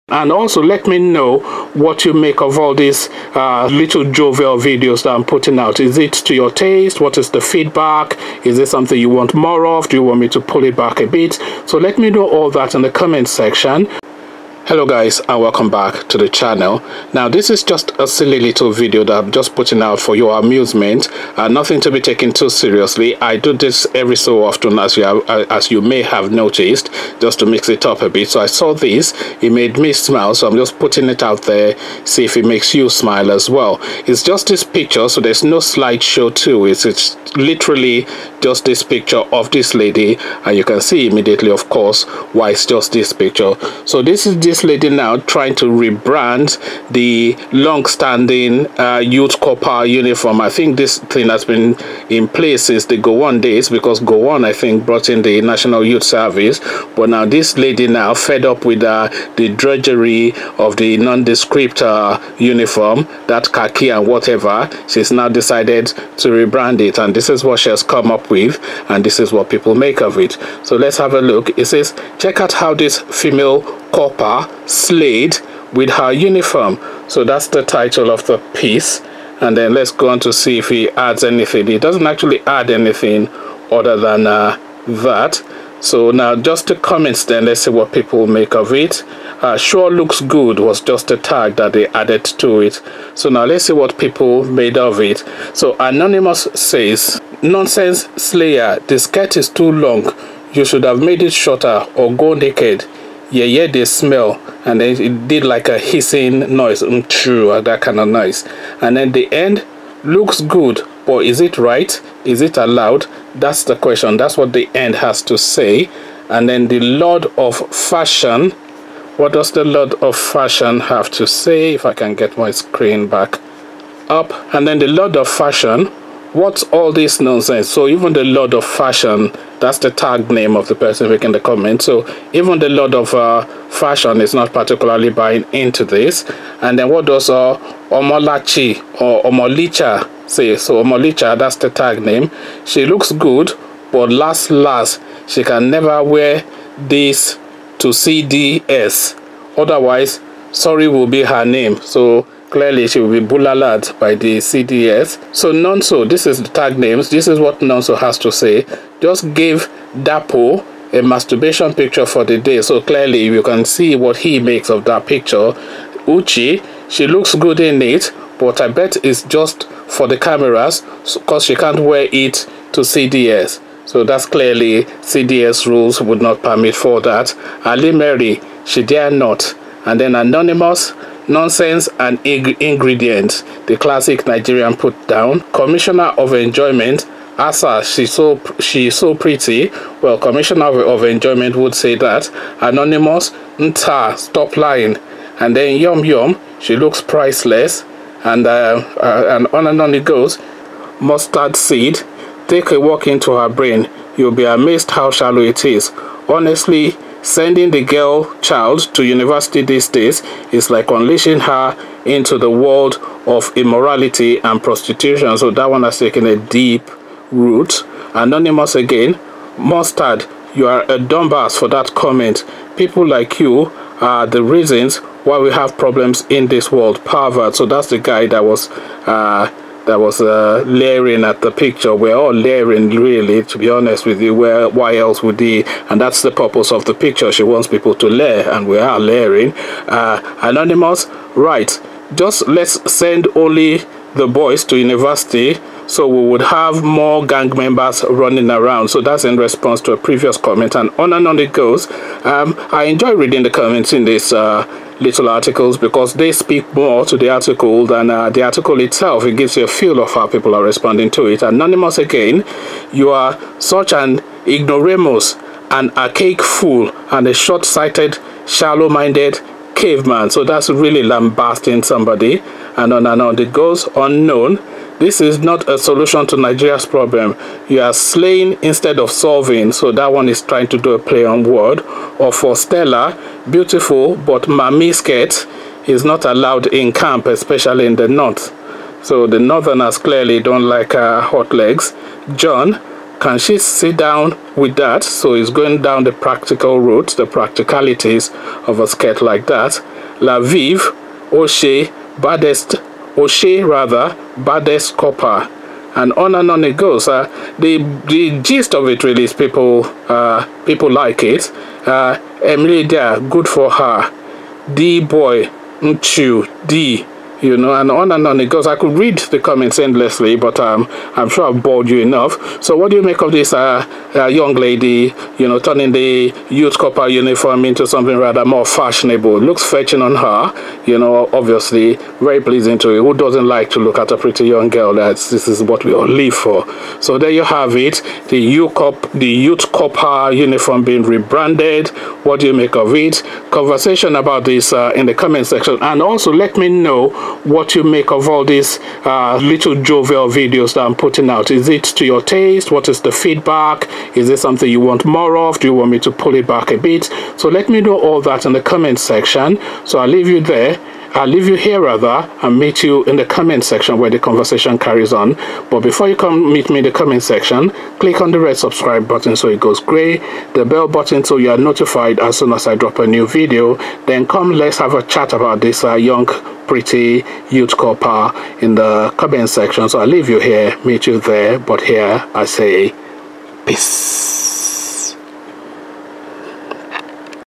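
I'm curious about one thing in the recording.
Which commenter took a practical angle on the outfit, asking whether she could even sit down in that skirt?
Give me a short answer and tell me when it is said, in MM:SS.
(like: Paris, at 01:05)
John, at 04:52.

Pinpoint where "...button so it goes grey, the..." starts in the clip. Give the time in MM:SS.
06:09.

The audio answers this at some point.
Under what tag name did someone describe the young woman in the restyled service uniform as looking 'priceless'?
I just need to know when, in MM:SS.
03:15.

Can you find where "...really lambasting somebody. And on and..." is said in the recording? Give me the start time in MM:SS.
04:30.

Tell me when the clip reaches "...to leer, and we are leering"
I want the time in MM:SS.
03:57.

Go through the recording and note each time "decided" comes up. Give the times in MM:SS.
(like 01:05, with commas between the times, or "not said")
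01:05.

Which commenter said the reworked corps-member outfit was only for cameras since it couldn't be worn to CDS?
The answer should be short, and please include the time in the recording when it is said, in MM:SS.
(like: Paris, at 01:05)
Uchi, at 02:46.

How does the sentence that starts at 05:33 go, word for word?
Who doesn't like to look at a pretty young girl?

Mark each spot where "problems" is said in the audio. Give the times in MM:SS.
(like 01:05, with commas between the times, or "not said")
03:45, 04:36.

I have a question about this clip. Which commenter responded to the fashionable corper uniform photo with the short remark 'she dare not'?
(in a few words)
Ali Mary.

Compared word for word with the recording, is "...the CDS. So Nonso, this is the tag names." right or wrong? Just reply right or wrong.
right.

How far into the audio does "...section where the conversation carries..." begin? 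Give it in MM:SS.
06:03.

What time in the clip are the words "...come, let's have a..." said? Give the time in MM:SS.
06:14.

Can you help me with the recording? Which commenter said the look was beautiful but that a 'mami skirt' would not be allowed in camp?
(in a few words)
Stella.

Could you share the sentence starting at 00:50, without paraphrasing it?
I think this thing has been in place since the Gowon days because Gowon, I think, brought in the National Youth Service.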